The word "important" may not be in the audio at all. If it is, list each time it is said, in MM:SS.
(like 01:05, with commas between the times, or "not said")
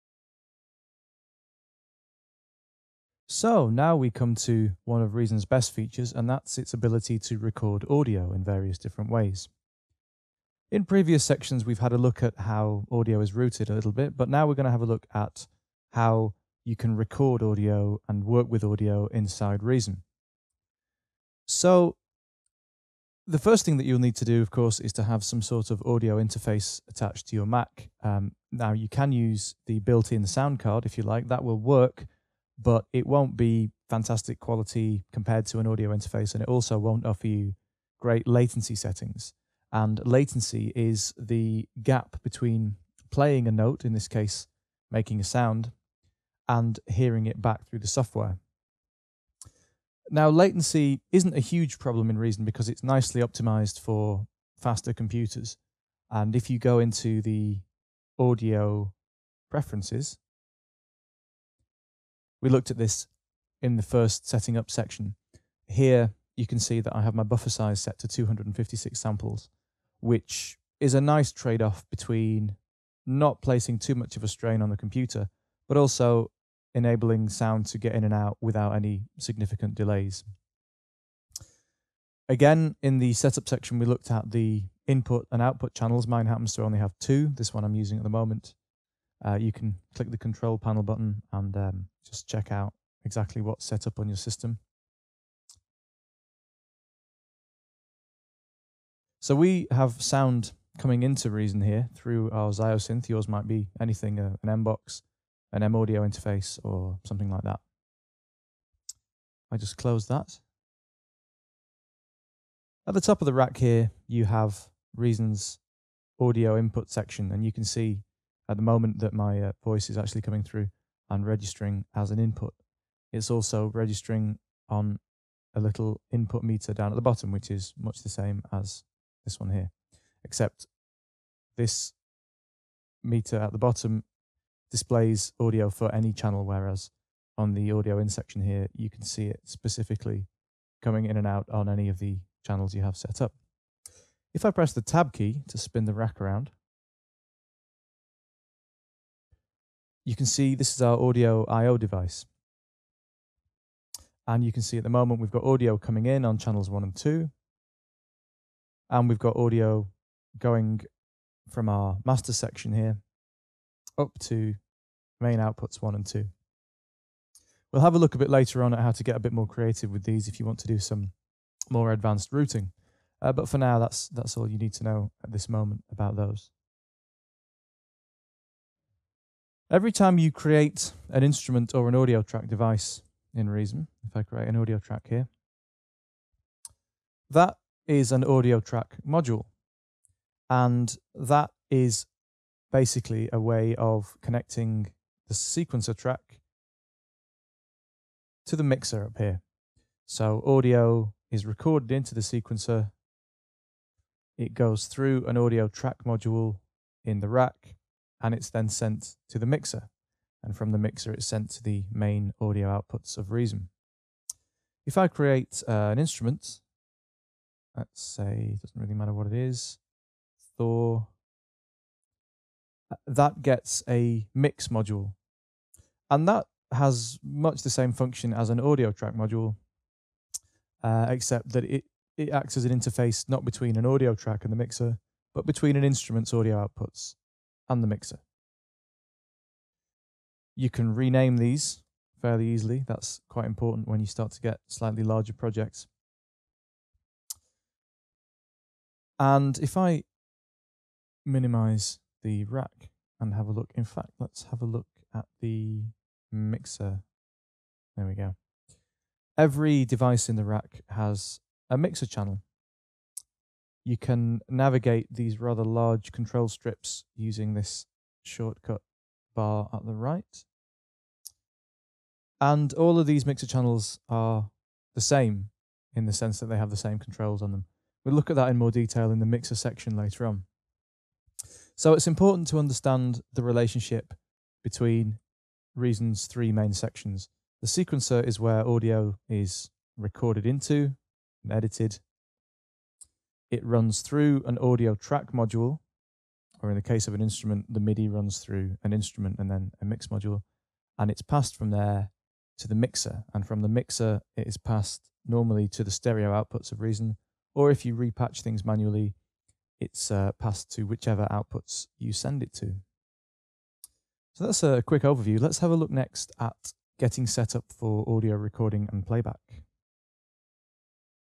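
04:03, 04:42.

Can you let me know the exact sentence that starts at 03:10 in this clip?
And that is basically a way of connecting the sequencer track to the mixer up here.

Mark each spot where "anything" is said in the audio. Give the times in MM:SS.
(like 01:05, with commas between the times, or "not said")
01:43.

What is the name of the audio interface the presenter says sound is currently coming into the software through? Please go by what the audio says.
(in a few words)
Ziosynth.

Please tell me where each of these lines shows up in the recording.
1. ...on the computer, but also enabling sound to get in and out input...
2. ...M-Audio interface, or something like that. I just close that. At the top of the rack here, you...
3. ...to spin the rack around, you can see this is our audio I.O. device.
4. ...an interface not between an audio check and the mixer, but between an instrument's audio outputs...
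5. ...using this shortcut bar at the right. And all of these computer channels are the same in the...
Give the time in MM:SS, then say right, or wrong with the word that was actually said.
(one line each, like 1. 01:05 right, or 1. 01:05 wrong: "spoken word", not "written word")
1. 01:14 wrong: "without", not "input"
2. 01:45 right
3. 02:25 right
4. 03:52 wrong: "track", not "check"
5. 04:27 wrong: "mixer", not "computer".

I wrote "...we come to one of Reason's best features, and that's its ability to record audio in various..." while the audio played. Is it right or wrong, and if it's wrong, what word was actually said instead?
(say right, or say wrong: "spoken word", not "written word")
right.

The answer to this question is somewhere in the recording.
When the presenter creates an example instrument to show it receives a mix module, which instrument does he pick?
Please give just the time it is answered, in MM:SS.
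03:40.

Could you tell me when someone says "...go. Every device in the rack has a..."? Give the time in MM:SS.
04:18.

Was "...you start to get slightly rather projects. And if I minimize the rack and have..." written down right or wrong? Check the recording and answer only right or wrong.
wrong.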